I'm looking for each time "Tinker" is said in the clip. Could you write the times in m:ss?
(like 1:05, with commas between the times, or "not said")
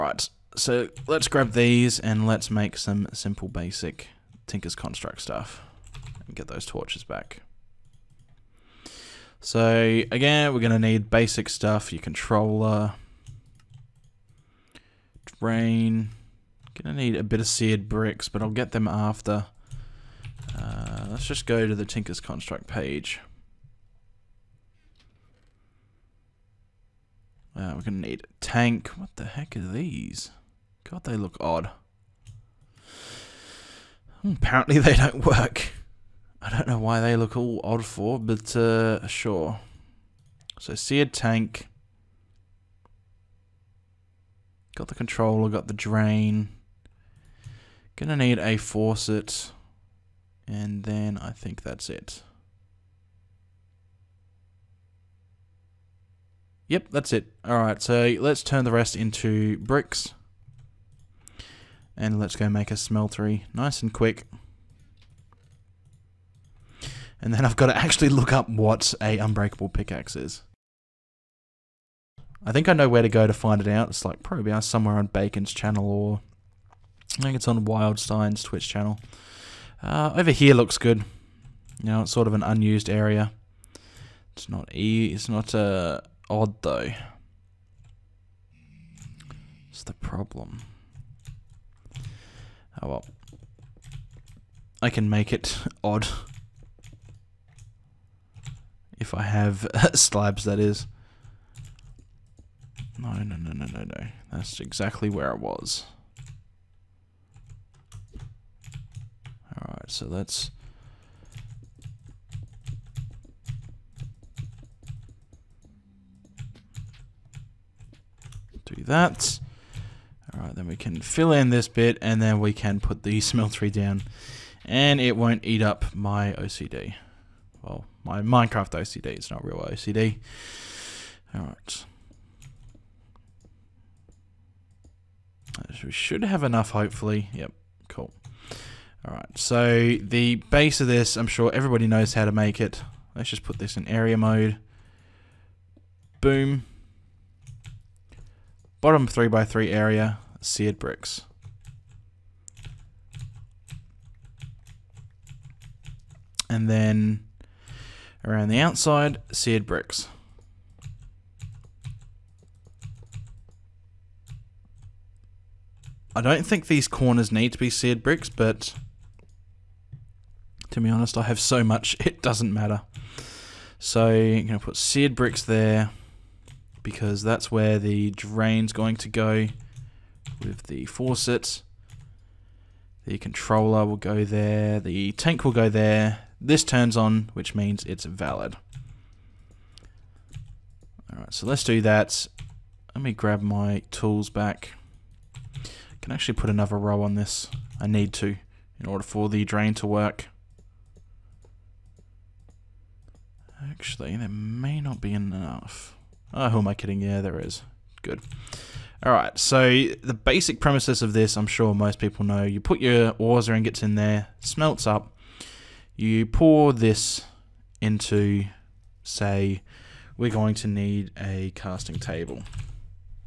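0:04, 0:21.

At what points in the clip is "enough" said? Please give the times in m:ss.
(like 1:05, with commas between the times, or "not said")
2:16, 3:25.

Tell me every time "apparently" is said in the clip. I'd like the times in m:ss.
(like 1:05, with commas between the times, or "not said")
0:34.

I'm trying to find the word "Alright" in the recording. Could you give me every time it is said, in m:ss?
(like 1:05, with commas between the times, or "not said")
0:57, 1:49, 3:11.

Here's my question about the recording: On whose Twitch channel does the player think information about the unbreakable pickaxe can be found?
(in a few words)
Wildstein.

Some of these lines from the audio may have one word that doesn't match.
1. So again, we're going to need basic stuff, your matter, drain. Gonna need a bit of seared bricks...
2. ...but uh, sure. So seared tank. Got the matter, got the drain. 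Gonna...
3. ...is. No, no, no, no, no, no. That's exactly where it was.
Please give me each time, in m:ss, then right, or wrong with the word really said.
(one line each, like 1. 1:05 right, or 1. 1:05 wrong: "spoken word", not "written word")
1. 0:09 wrong: "controller", not "matter"
2. 0:38 wrong: "controller", not "matter"
3. 1:40 right.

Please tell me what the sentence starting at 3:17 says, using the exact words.
I need to in order for the drain to work.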